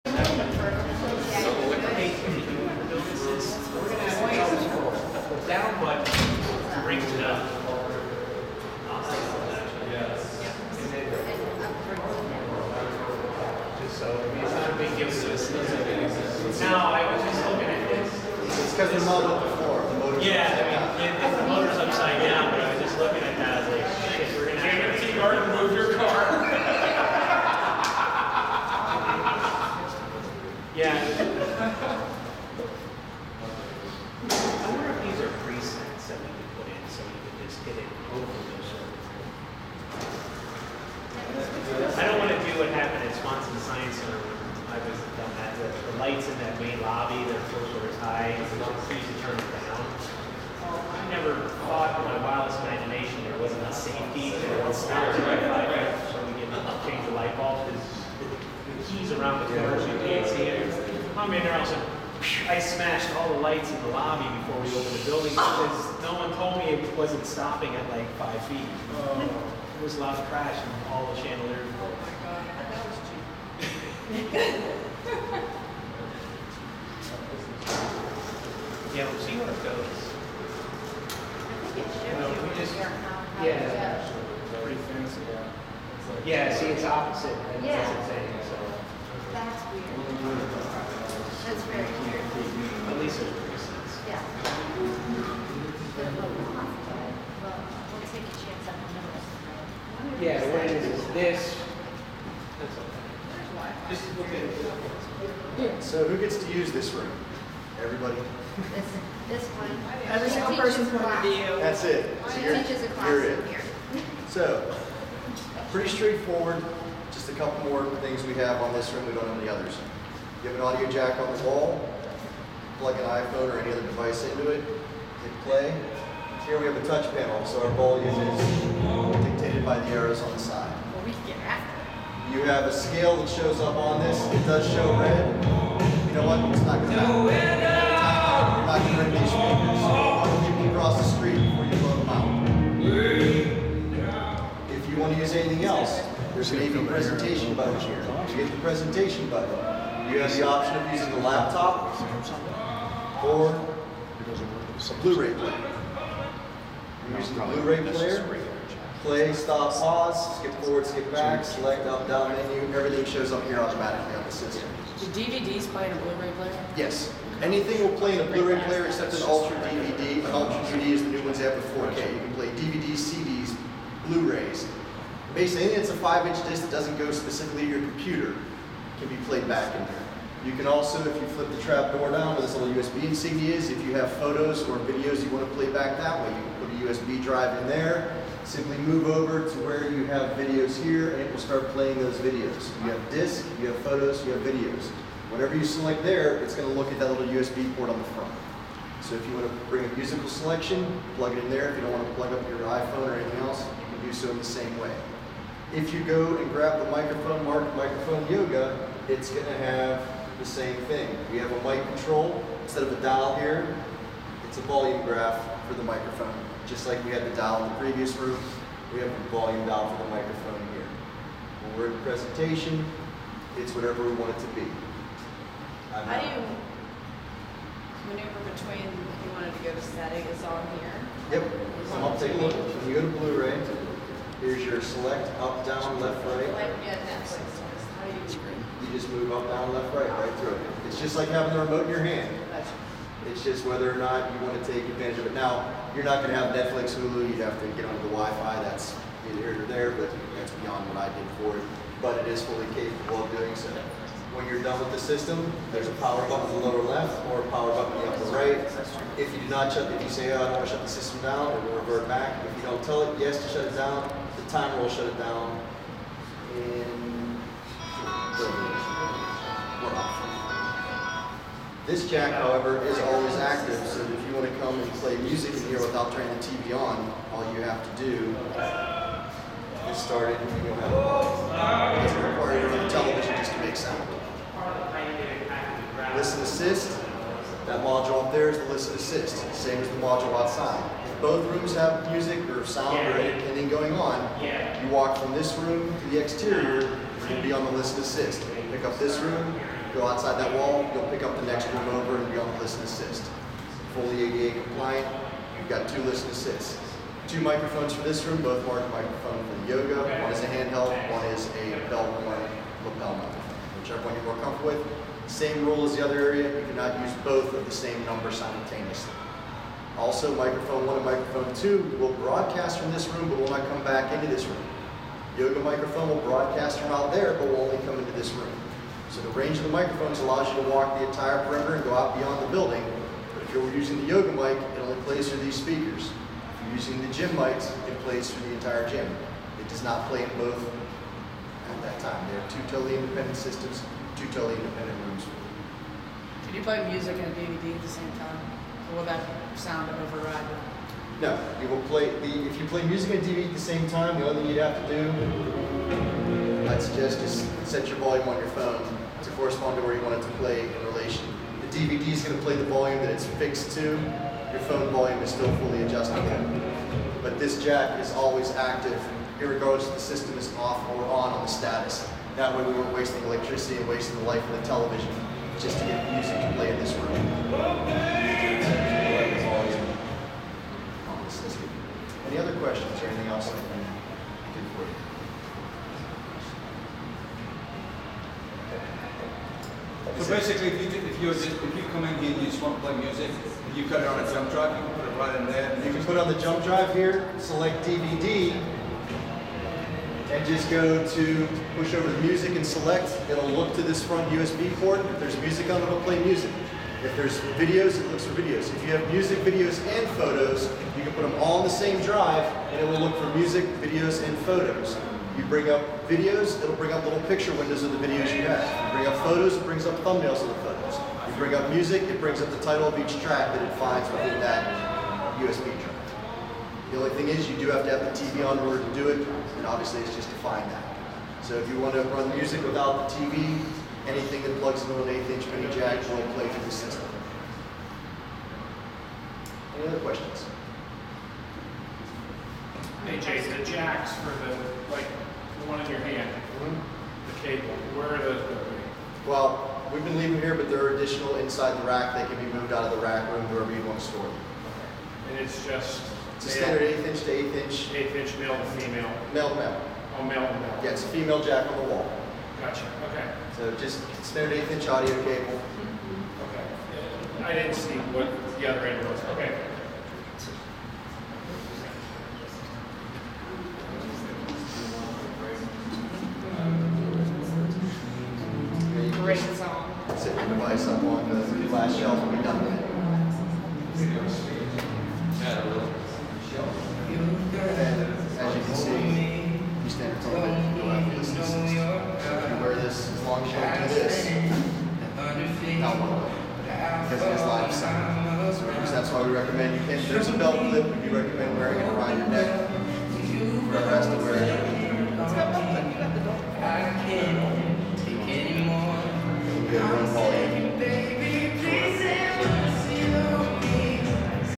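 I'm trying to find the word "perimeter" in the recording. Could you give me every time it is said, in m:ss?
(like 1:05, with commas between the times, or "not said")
5:31.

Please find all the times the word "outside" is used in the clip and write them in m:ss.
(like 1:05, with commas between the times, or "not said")
4:50, 5:00.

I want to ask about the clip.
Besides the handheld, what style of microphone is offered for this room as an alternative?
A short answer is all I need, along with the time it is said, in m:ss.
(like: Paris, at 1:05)
belt lapel microphone, at 5:11.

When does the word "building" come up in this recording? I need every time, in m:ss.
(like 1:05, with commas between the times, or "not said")
1:05, 5:32.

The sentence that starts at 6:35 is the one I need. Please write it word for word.
and You can put on the jump drive here, select DVD, and just go to push over to music and select.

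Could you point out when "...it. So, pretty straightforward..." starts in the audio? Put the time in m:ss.
1:53.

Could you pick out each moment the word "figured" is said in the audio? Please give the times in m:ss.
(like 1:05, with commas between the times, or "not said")
not said.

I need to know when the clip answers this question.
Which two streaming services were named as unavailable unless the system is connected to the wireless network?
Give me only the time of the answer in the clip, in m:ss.
4:06.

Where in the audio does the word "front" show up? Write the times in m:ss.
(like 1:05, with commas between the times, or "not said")
3:18, 6:44.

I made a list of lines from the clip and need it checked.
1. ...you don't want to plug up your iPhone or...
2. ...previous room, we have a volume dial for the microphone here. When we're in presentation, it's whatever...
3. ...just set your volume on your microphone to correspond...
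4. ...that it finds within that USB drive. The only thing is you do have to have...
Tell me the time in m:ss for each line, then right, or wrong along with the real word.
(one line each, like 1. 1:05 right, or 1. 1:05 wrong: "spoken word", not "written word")
1. 3:21 right
2. 3:37 right
3. 5:57 wrong: "phone", not "microphone"
4. 7:03 right.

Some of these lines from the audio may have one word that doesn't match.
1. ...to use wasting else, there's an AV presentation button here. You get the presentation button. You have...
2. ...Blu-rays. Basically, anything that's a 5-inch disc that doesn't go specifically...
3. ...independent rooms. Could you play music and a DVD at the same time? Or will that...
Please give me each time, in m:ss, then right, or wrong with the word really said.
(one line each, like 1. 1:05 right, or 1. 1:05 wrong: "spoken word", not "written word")
1. 2:25 wrong: "anything", not "wasting"
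2. 2:54 right
3. 5:44 right.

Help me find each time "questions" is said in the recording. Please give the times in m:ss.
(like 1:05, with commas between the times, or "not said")
6:22, 7:19.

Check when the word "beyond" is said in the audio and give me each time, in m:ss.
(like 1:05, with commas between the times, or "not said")
4:10, 5:32.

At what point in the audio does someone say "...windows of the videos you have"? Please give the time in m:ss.
6:57.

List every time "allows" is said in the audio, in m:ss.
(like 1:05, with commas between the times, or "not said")
5:30.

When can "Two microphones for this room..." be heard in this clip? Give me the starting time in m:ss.
5:07.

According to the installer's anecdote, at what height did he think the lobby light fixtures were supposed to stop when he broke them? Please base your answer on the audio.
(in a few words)
5 feet.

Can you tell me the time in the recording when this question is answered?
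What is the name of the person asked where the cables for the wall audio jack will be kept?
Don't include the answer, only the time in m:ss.
7:23.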